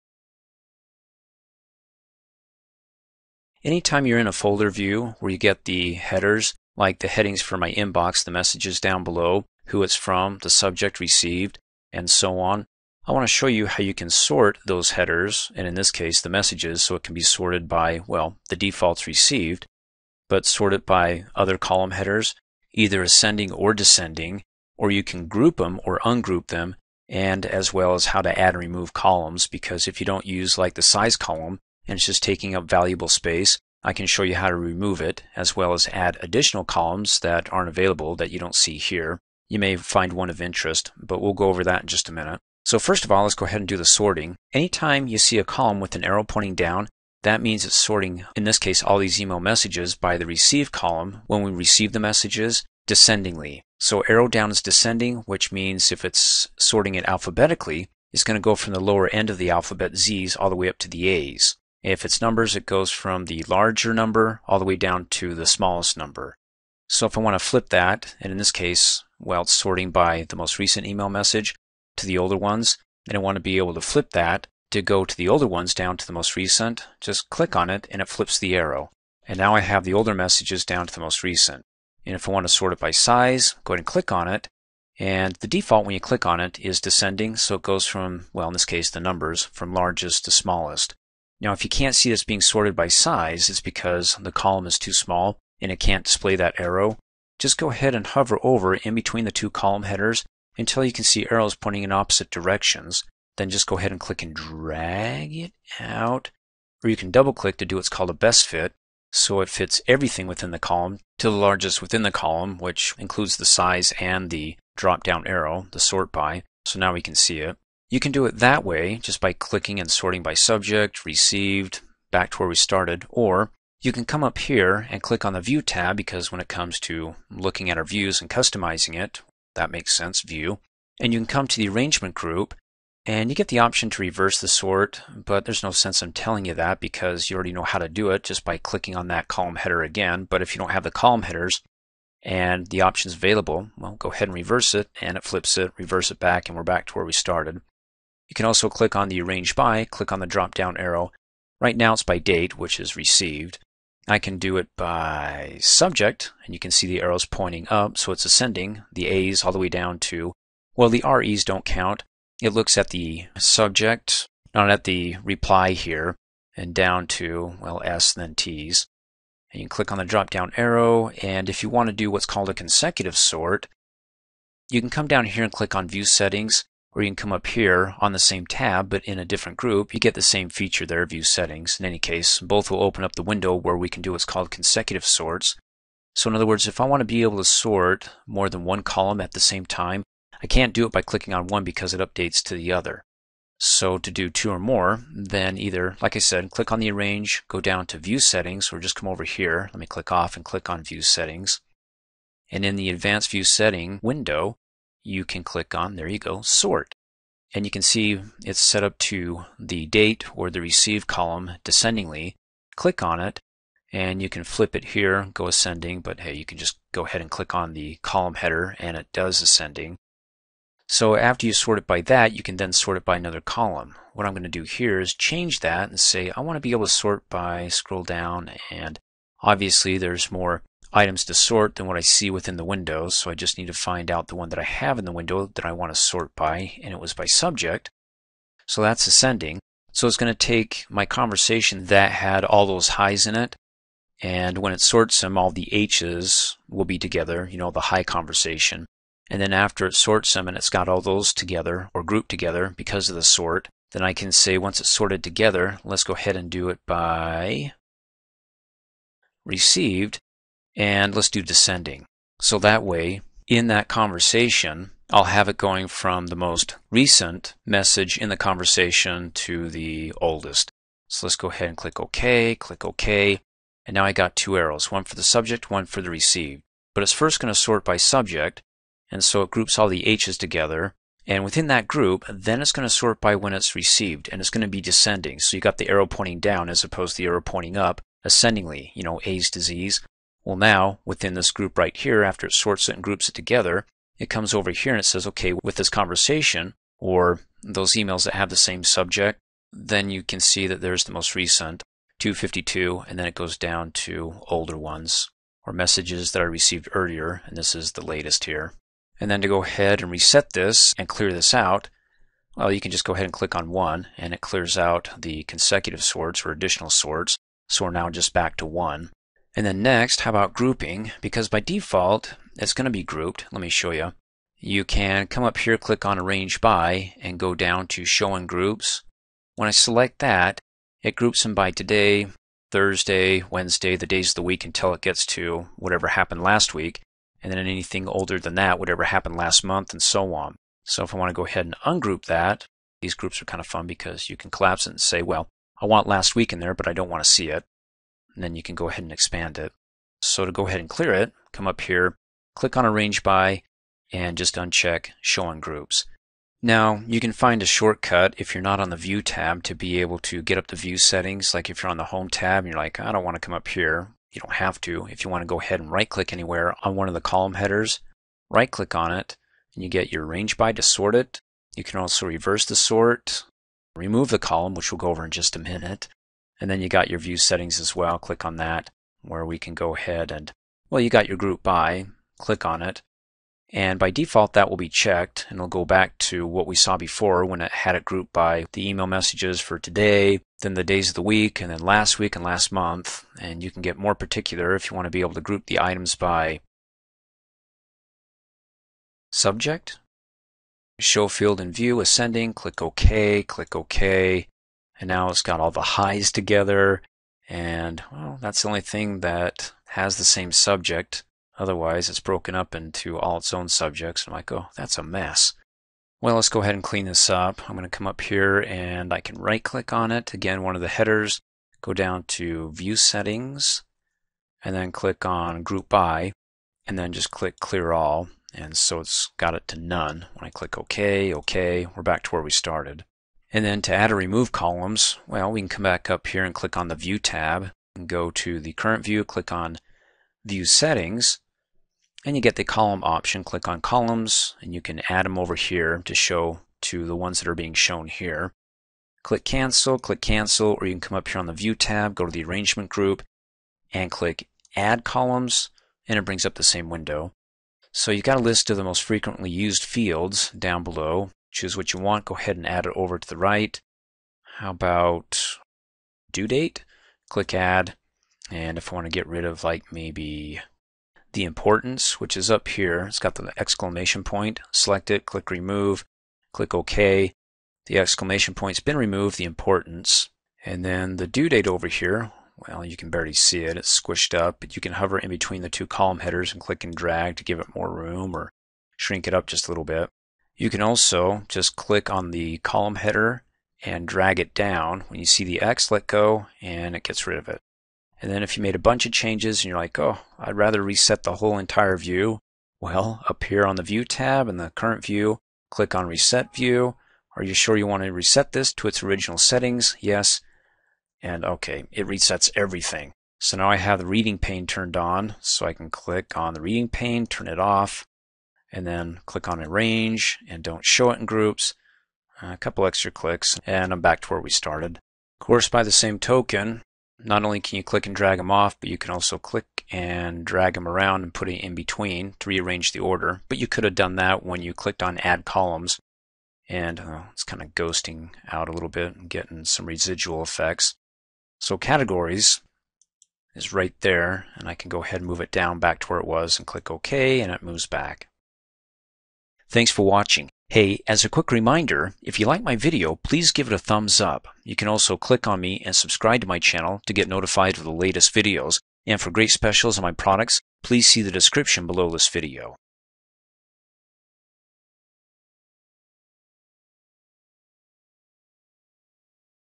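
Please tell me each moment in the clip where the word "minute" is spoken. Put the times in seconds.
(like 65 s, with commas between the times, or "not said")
42 s, 375 s.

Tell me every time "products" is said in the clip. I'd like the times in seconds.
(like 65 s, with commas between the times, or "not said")
560 s.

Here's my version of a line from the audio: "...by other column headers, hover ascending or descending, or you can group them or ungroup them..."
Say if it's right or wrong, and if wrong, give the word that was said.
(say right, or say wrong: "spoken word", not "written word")
wrong: "either", not "hover".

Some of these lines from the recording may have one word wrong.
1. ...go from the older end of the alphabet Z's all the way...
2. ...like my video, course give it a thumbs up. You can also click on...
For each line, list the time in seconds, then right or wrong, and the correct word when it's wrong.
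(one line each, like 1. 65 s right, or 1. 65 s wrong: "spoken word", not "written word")
1. 58 s wrong: "lower", not "older"
2. 552 s wrong: "please", not "course".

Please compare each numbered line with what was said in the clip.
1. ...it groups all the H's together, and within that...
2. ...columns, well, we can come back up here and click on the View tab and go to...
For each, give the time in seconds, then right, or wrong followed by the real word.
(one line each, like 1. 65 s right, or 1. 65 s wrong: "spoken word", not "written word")
1. 279 s right
2. 434 s right.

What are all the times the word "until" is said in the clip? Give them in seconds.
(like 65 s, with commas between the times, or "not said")
100 s, 334 s.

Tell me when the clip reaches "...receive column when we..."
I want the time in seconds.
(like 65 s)
50 s.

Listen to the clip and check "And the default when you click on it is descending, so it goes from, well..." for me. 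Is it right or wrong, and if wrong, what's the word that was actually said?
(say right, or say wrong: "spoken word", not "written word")
right.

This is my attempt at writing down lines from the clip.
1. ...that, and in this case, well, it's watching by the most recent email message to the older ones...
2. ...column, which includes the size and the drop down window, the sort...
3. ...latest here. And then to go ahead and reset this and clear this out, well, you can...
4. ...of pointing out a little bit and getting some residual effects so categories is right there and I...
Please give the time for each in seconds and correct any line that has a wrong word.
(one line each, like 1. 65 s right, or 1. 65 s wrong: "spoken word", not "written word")
1. 67 s wrong: "sorting", not "watching"
2. 112 s wrong: "arrow", not "window"
3. 308 s right
4. 537 s wrong: "ghosting", not "pointing".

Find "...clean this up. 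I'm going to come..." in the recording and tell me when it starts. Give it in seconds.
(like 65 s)
416 s.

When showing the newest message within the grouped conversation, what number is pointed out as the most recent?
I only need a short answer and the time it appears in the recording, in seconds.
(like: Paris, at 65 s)
252, at 302 s.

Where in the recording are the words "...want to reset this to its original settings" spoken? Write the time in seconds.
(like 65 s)
507 s.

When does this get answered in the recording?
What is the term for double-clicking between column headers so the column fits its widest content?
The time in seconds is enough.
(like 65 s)
108 s.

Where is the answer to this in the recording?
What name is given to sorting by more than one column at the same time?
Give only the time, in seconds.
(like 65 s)
172 s.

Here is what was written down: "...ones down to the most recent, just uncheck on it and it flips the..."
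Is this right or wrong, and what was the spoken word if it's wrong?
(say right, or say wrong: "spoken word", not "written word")
wrong: "click", not "uncheck".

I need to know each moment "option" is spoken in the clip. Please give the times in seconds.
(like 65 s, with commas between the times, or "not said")
133 s, 142 s, 443 s.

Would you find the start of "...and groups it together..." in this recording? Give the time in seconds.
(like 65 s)
292 s.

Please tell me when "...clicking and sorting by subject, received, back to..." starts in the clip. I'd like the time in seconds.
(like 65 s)
119 s.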